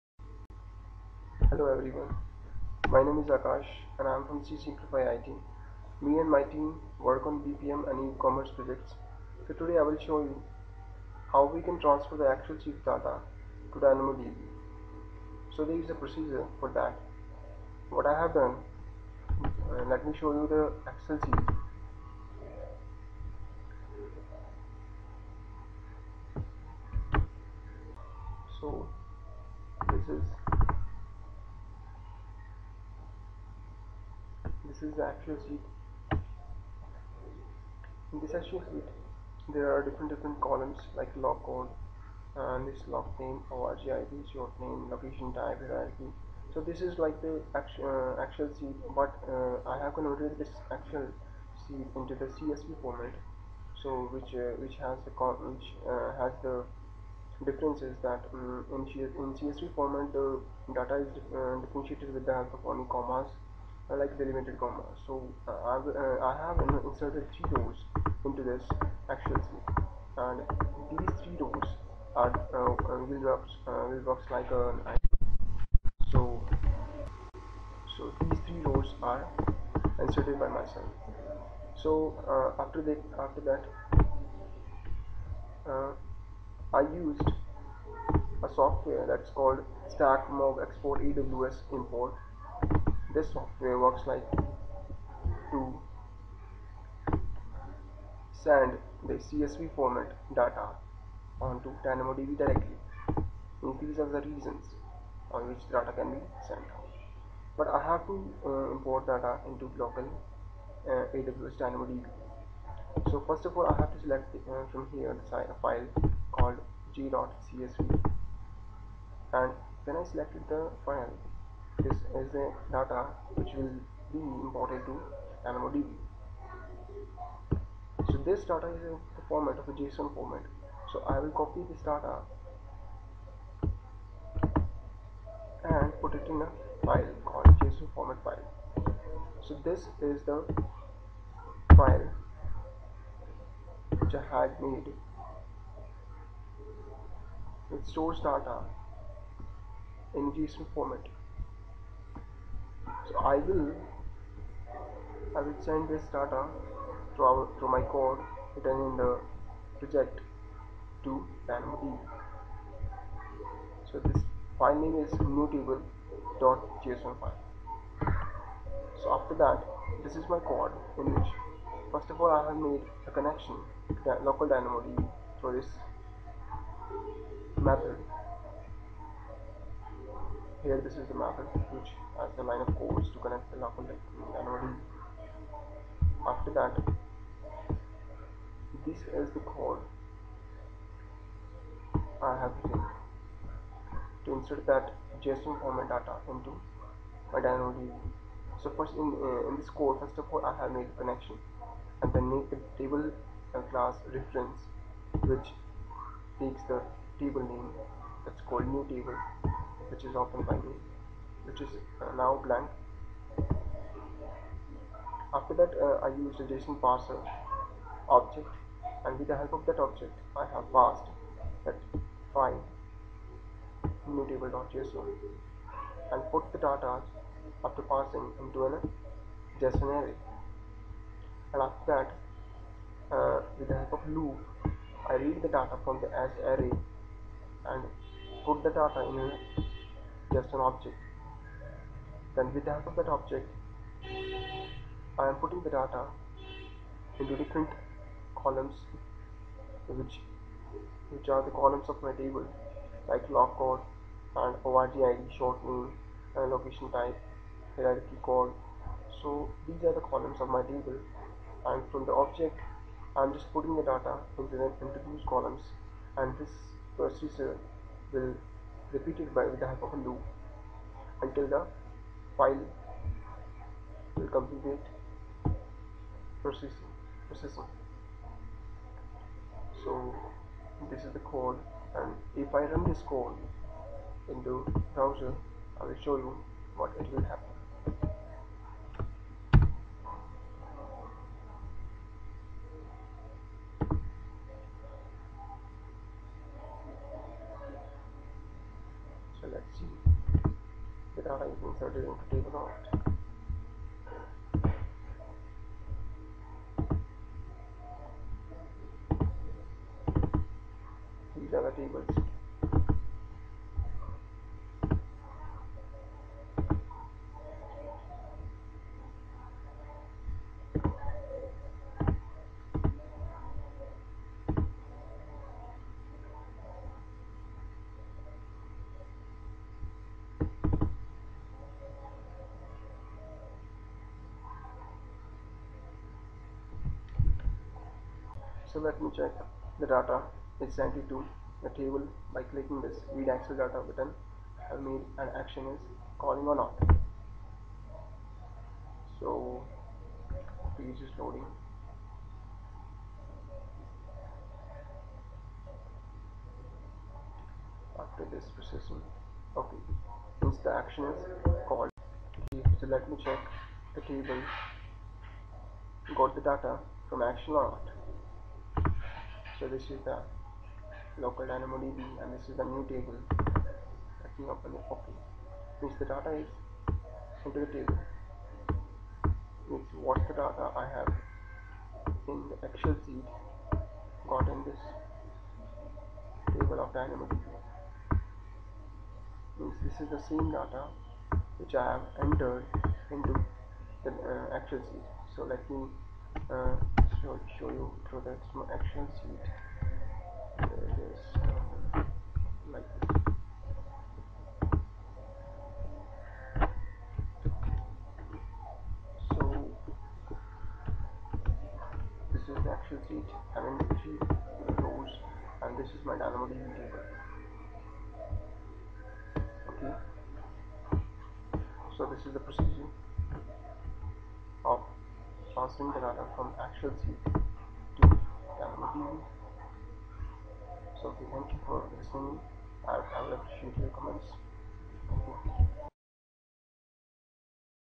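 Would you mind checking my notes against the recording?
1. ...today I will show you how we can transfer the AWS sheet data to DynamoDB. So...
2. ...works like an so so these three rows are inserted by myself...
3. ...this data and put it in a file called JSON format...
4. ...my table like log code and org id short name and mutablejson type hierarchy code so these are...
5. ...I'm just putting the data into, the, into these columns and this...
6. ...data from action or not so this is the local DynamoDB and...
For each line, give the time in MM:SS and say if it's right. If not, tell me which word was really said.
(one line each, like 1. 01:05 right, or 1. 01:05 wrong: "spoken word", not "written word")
1. 00:09 wrong: "Excel", not "AWS"
2. 01:14 right
3. 02:11 right
4. 04:12 wrong: "location", not "mutablejson"
5. 04:23 right
6. 06:06 right.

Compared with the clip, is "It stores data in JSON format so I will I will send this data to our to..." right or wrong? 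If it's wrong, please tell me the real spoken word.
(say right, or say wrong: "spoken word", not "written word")
right.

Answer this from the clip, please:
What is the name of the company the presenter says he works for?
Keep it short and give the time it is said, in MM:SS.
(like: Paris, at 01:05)
C Simplify IT, at 00:04.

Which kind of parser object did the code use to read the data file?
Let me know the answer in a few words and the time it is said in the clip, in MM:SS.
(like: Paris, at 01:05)
JSON parser, at 03:36.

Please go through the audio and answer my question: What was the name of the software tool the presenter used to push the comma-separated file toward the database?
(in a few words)
stack mob export aws import.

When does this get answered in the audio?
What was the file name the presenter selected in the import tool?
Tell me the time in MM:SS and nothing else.
01:56.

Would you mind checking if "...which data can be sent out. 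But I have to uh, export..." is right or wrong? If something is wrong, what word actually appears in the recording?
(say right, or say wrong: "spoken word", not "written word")
wrong: "import", not "export".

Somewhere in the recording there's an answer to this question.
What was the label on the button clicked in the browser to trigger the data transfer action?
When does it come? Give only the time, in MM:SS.
05:43.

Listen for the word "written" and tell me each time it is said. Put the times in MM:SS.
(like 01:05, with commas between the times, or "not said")
02:38, 03:12.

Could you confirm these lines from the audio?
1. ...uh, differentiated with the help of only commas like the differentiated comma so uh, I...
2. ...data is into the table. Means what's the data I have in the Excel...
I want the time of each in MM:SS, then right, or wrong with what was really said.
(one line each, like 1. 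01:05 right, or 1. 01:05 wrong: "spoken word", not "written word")
1. 01:01 wrong: "limited", not "differentiated"
2. 06:16 right.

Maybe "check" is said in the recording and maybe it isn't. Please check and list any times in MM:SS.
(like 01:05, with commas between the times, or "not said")
05:39, 06:03.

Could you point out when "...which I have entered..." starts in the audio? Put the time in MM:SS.
06:31.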